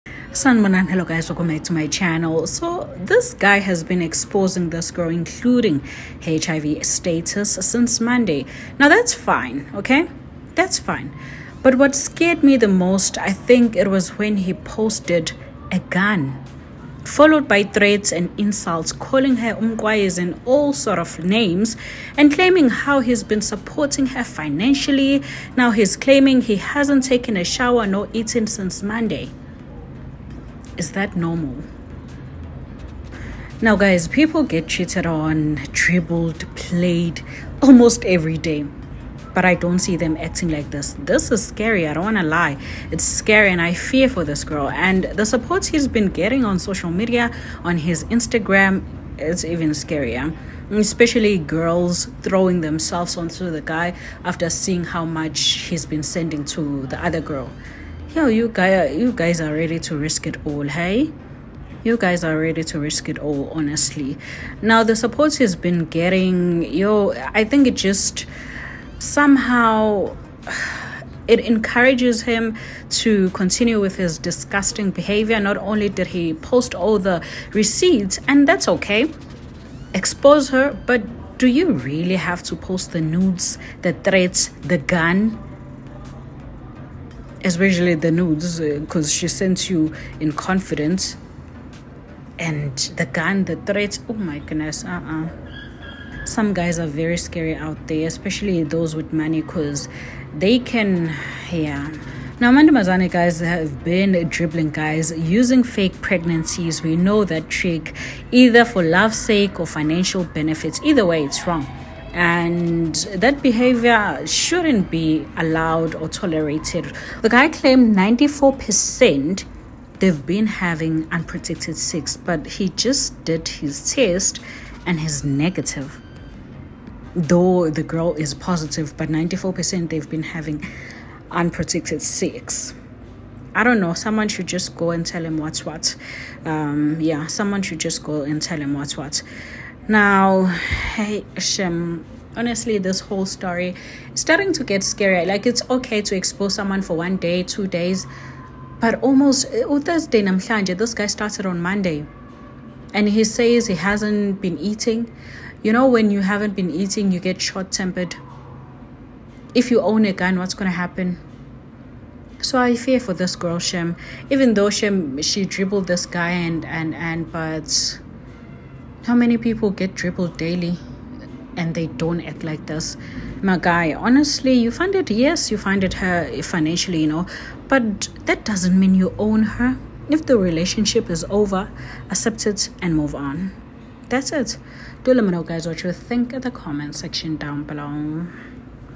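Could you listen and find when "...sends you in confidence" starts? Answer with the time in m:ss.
1:29.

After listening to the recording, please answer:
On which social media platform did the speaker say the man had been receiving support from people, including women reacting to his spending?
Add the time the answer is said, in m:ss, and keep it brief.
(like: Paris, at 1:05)
Instagram, at 0:48.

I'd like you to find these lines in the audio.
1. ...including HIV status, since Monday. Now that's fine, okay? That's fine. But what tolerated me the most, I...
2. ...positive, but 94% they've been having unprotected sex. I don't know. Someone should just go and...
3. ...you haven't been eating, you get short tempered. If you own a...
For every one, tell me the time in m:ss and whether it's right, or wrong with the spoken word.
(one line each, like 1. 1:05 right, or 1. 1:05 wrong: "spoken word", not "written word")
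1. 0:05 wrong: "scared", not "tolerated"
2. 2:08 right
3. 2:36 right.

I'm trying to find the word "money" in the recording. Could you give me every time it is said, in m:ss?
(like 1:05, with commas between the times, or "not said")
1:39.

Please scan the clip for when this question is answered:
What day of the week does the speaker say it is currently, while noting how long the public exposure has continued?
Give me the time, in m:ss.
2:29.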